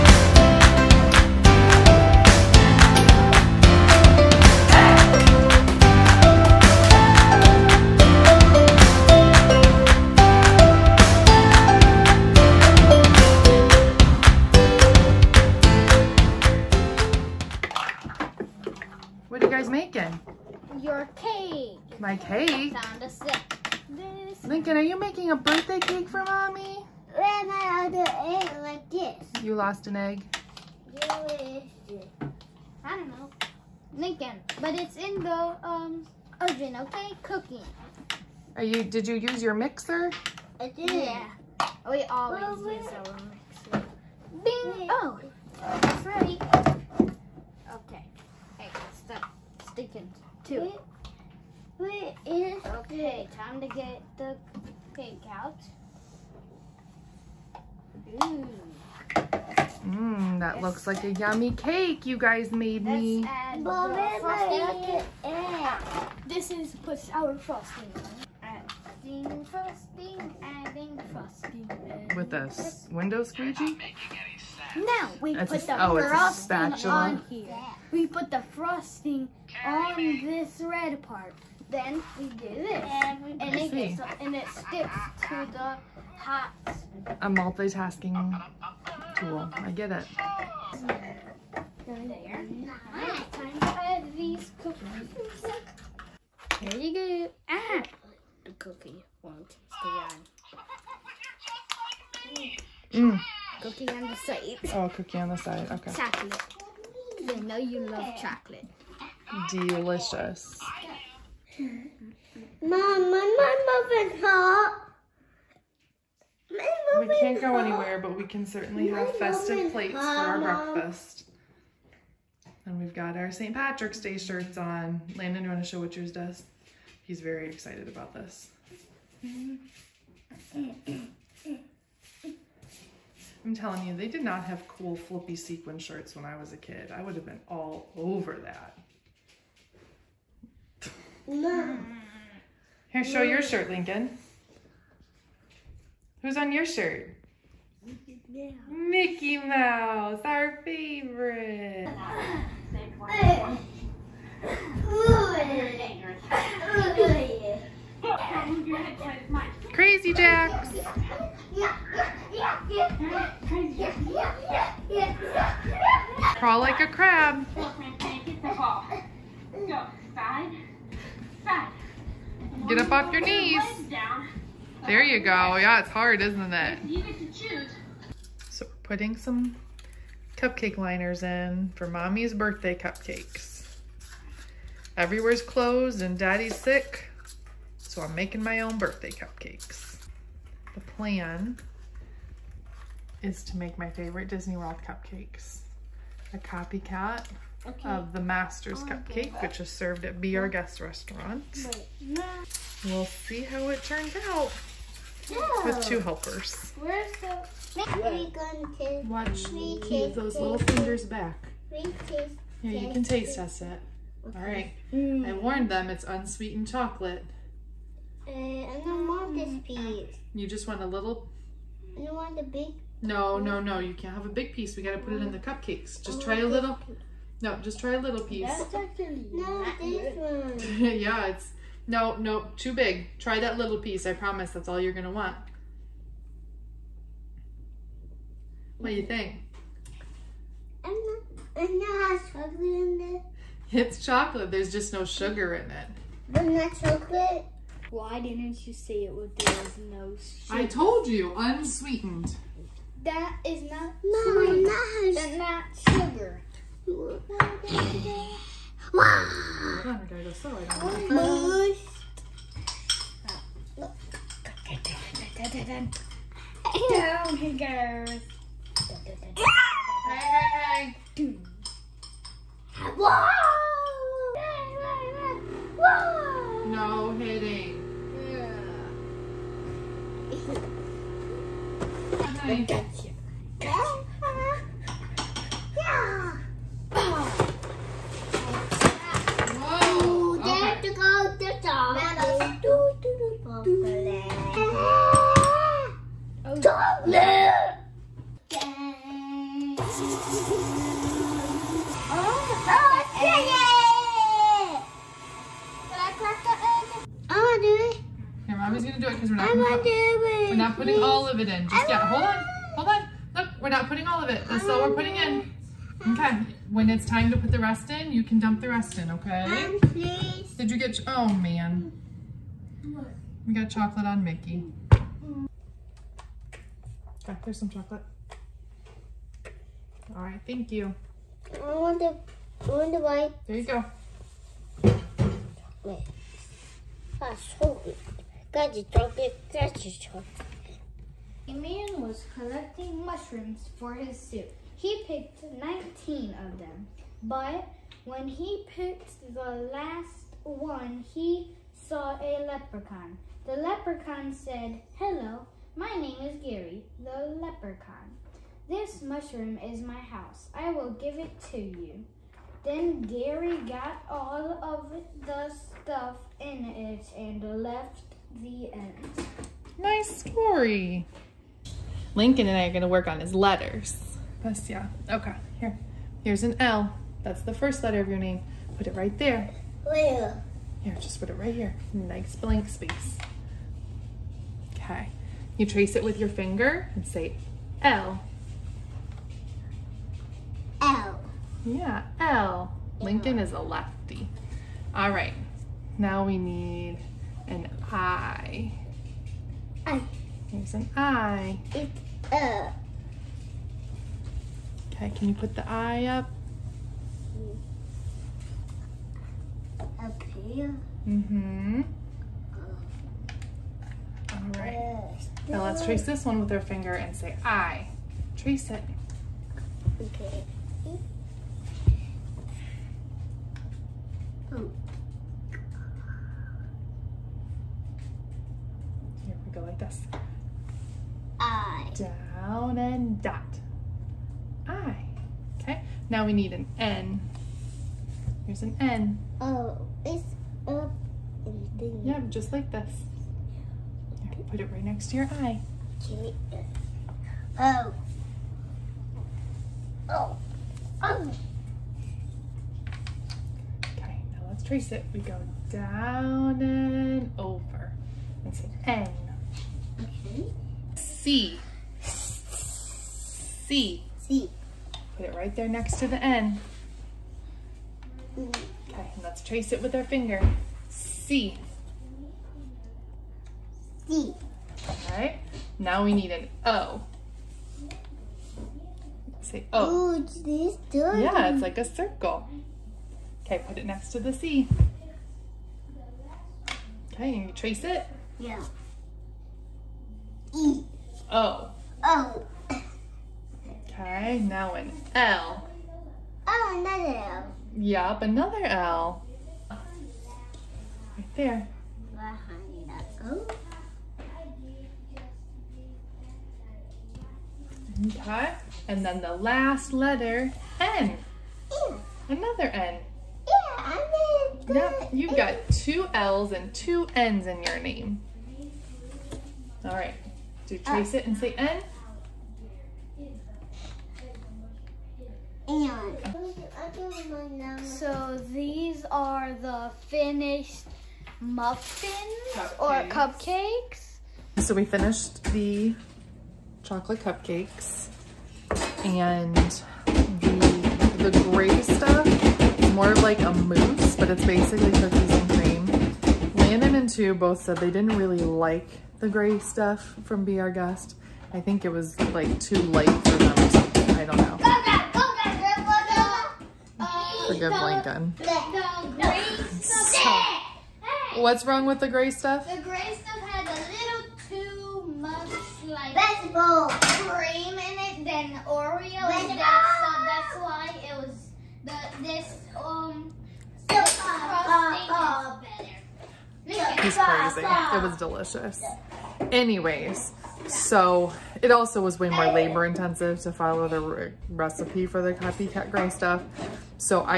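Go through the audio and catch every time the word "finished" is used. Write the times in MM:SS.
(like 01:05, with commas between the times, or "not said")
08:50, 08:54.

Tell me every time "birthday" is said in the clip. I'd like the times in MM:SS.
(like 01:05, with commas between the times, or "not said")
00:25, 03:02, 03:08.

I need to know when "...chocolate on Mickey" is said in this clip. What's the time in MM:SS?
05:23.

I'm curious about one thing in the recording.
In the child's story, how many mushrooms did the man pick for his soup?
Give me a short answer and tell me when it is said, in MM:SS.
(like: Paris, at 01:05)
19, at 05:45.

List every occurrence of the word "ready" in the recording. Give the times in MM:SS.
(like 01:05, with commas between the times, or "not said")
00:46.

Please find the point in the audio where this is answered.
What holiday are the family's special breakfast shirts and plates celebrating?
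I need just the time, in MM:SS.
02:03.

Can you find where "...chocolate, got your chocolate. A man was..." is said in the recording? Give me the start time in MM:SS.
05:38.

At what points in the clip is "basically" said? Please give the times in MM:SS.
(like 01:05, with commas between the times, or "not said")
09:04.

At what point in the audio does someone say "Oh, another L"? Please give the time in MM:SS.
08:16.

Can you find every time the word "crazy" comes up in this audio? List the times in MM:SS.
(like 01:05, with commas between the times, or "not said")
02:39, 09:37.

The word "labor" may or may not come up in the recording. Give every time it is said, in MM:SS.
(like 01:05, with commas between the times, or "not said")
09:42.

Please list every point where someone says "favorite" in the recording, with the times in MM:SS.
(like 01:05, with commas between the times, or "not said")
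02:30, 03:13.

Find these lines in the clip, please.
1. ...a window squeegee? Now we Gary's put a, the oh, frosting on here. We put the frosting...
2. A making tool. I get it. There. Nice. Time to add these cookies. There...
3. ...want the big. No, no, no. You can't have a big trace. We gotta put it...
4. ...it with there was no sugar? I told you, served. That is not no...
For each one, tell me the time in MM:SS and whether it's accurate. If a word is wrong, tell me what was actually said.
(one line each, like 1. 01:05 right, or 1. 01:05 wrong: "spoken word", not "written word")
1. 01:12 wrong: "That", not "Gary"
2. 01:27 wrong: "multitasking", not "making"
3. 03:42 wrong: "piece", not "trace"
4. 04:09 wrong: "unsweetened", not "served".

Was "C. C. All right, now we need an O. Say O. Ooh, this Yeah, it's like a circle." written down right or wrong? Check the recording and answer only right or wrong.
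right.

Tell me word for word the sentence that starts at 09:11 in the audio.
I think it was like too light for them or something.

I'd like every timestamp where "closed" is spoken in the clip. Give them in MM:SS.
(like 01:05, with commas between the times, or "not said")
03:05.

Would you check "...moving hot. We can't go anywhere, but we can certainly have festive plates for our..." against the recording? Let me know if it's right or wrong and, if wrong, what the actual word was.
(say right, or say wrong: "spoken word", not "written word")
right.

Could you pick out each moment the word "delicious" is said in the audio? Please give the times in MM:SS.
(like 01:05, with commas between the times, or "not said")
01:49, 09:38.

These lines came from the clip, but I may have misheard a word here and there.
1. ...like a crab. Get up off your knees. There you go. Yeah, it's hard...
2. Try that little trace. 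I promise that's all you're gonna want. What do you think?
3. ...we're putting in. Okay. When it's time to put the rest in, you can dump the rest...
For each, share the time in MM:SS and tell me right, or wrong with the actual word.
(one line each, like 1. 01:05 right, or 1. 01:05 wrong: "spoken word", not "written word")
1. 02:46 right
2. 03:53 wrong: "piece", not "trace"
3. 05:14 right.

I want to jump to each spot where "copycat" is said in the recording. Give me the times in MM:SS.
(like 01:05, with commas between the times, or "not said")
03:16, 09:45.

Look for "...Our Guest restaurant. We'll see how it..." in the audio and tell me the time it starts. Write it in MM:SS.
03:20.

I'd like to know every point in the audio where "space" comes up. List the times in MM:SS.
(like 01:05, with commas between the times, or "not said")
06:22.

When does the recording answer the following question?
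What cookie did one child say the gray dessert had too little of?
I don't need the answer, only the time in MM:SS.
09:28.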